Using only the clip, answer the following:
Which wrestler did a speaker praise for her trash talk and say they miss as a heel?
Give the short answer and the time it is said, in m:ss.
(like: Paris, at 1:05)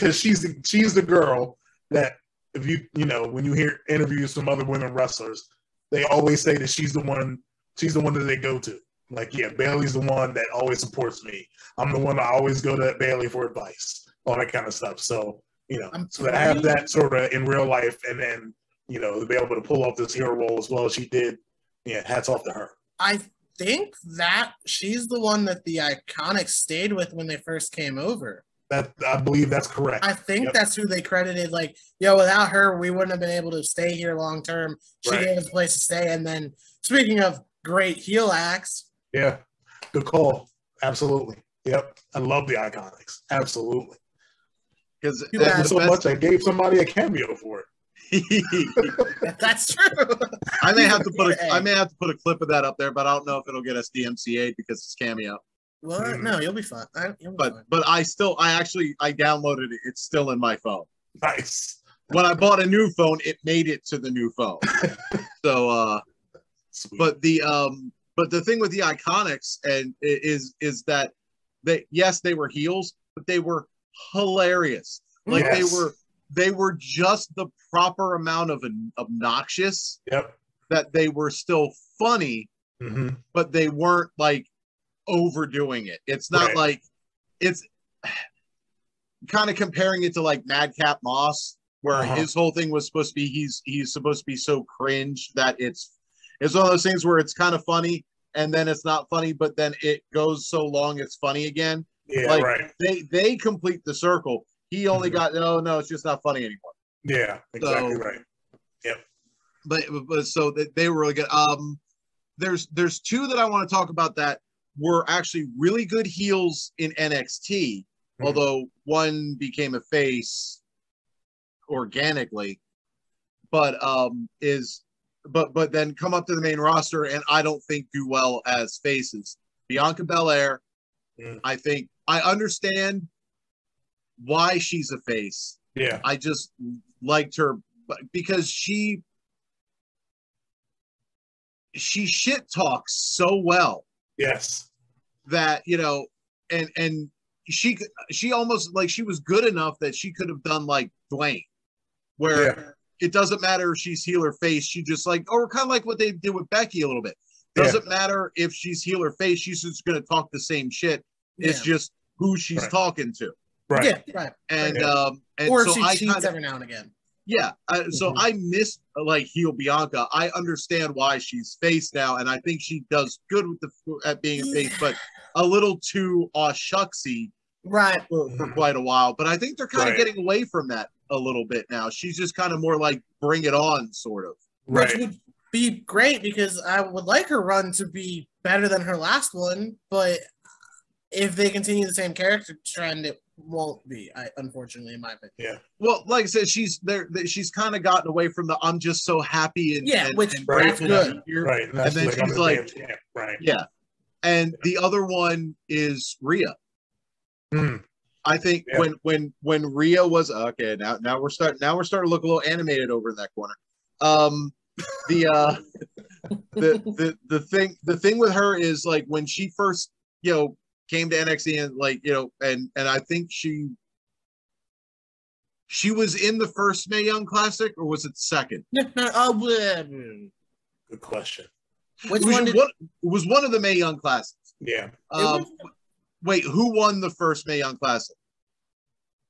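Bianca Belair, at 2:09.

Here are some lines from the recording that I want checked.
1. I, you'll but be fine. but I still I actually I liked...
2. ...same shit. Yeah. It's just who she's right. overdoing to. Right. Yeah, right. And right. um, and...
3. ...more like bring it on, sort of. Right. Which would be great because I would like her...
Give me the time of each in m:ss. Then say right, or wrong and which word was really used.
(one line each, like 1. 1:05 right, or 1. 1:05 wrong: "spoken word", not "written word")
1. 0:56 wrong: "downloaded", not "liked"
2. 2:40 wrong: "talking", not "overdoing"
3. 3:02 right.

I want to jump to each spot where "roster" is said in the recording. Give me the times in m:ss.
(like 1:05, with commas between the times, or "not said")
2:06.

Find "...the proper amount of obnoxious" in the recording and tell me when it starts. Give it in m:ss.
1:17.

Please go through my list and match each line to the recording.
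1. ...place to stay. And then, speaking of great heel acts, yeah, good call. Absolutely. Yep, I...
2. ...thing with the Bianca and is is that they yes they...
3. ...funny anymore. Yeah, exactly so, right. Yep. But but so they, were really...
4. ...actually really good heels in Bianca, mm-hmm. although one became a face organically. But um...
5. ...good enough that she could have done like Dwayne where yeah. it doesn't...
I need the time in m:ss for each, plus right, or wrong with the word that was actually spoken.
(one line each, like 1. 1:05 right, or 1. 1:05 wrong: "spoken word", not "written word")
1. 0:35 right
2. 1:08 wrong: "Iconics", not "Bianca"
3. 1:46 right
4. 1:55 wrong: "NXT", not "Bianca"
5. 2:29 right.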